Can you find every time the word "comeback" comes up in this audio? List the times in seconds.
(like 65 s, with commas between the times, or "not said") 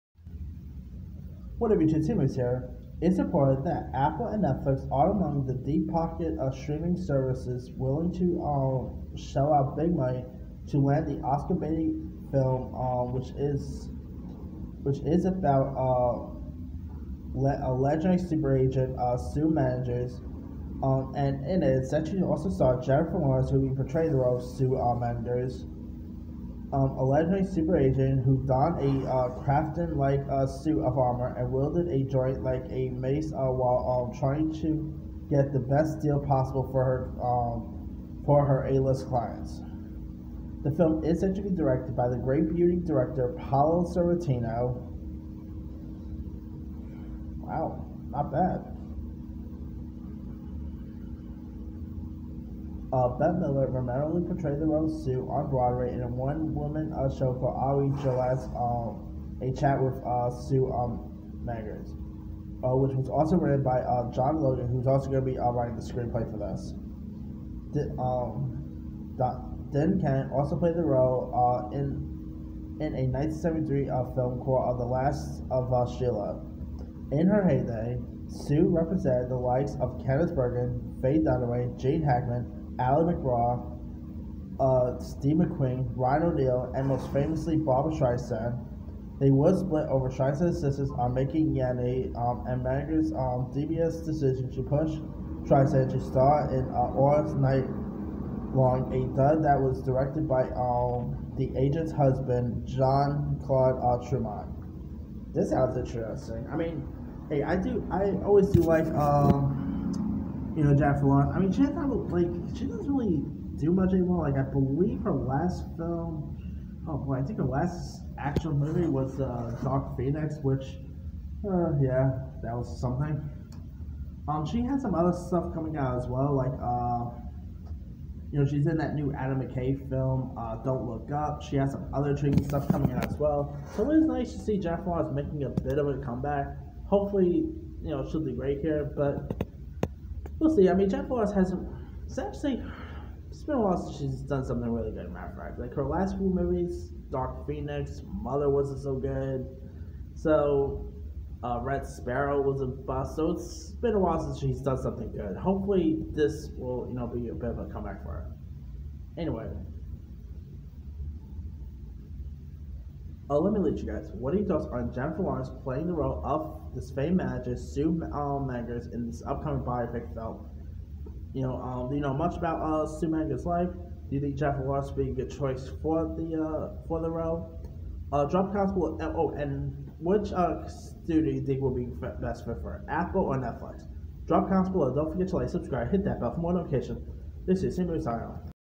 135 s, 157 s.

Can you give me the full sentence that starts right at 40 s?
The film is to be directed by the great beauty director Paolo Sorrentino.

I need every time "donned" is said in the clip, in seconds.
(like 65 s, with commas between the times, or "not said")
28 s.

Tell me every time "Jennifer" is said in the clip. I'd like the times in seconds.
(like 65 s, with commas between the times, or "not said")
22 s, 134 s, 140 s, 164 s, 174 s.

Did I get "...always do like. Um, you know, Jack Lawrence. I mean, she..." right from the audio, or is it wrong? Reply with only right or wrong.
right.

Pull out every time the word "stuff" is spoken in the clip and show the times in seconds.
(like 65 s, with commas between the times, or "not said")
125 s, 132 s.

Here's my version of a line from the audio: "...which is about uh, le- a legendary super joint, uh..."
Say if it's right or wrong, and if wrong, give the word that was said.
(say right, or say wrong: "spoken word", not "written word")
wrong: "agent", not "joint".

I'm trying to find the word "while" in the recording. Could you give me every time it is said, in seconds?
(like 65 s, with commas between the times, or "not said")
33 s, 143 s, 153 s.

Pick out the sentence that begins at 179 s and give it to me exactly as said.
Oh, and which uh, studio do you think will be best fit for Apple or Netflix?